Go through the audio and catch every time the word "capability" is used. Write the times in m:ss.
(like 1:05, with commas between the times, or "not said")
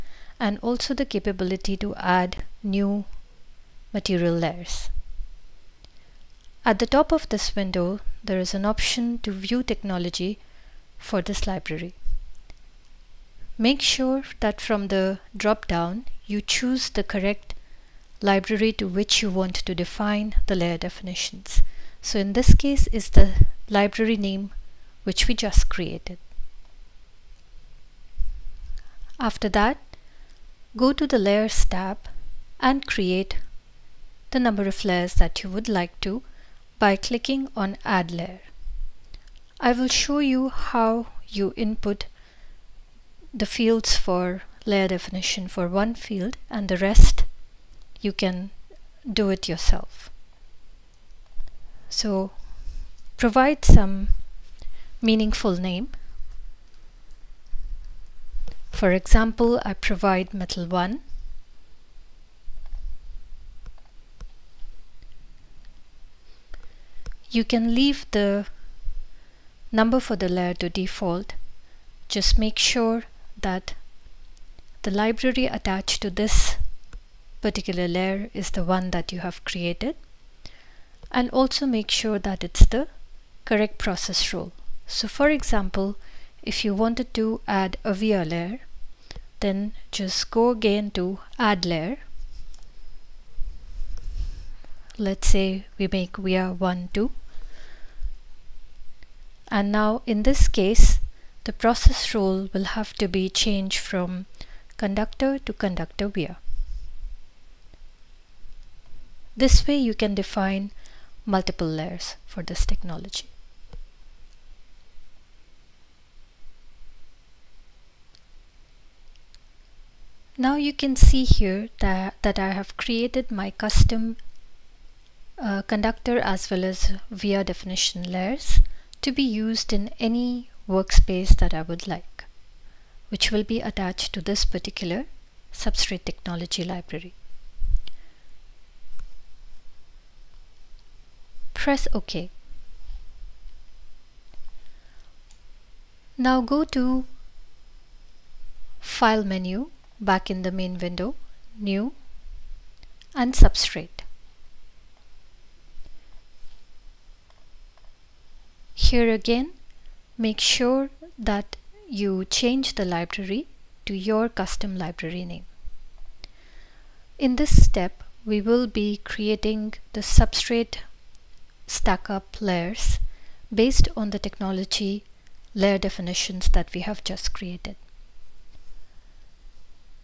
0:01.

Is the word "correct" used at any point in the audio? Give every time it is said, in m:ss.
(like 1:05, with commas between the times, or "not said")
0:17, 1:23.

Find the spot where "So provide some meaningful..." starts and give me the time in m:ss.
0:51.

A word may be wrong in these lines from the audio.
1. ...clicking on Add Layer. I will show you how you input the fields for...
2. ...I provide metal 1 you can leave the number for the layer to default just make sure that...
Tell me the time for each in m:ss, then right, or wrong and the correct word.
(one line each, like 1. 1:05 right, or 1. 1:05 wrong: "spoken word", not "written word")
1. 0:36 right
2. 0:59 right.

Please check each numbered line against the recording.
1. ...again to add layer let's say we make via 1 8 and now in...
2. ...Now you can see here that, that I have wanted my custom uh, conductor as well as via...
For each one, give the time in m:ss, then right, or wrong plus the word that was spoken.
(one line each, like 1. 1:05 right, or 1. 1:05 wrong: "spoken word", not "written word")
1. 1:30 wrong: "2", not "8"
2. 2:00 wrong: "created", not "wanted".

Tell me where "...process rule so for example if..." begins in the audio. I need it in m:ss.
1:23.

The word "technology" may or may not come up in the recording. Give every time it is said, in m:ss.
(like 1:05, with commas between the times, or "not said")
0:09, 1:52, 2:16, 2:54.